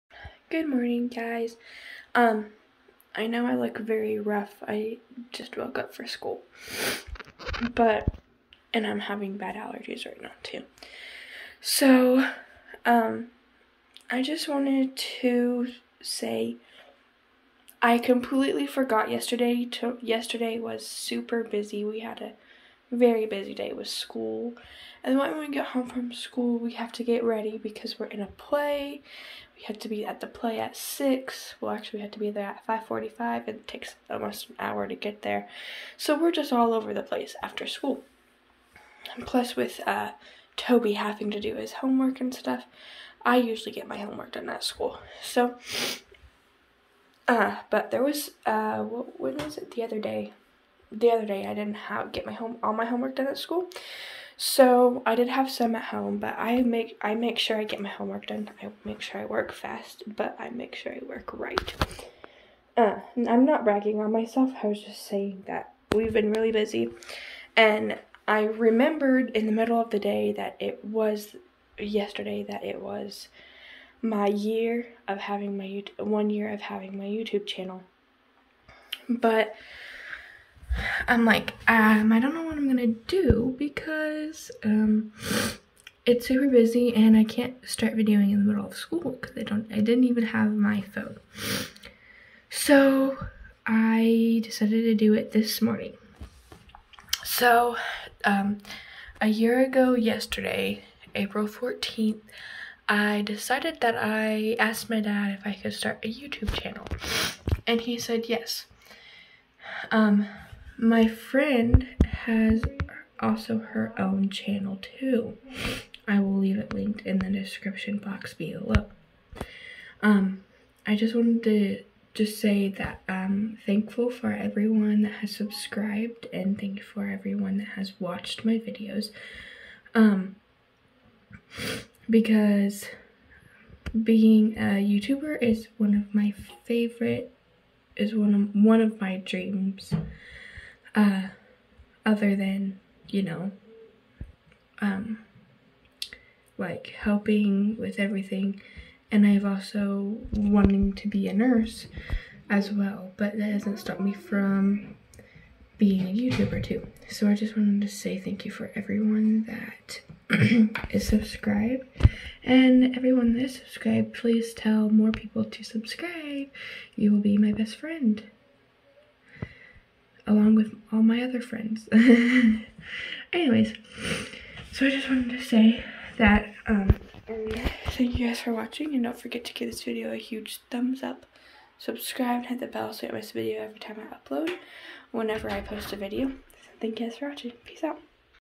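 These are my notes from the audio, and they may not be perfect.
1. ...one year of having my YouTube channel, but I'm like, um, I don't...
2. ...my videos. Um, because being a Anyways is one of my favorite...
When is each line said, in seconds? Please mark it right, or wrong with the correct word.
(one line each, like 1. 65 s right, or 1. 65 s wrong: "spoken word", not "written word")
1. 75 s right
2. 128 s wrong: "YouTuber", not "Anyways".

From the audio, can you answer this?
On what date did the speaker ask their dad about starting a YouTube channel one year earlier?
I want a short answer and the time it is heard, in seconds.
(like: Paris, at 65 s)
April 14th, at 101 s.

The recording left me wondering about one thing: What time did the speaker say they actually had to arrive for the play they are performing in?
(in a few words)
5:45.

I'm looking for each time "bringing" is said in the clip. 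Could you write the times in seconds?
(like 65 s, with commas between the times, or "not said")
not said.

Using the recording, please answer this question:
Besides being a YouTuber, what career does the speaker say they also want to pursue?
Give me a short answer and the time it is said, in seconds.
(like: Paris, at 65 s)
Nurse, at 151 s.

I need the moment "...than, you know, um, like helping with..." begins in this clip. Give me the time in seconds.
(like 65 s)
142 s.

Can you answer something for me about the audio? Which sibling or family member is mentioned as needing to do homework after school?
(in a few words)
Toby.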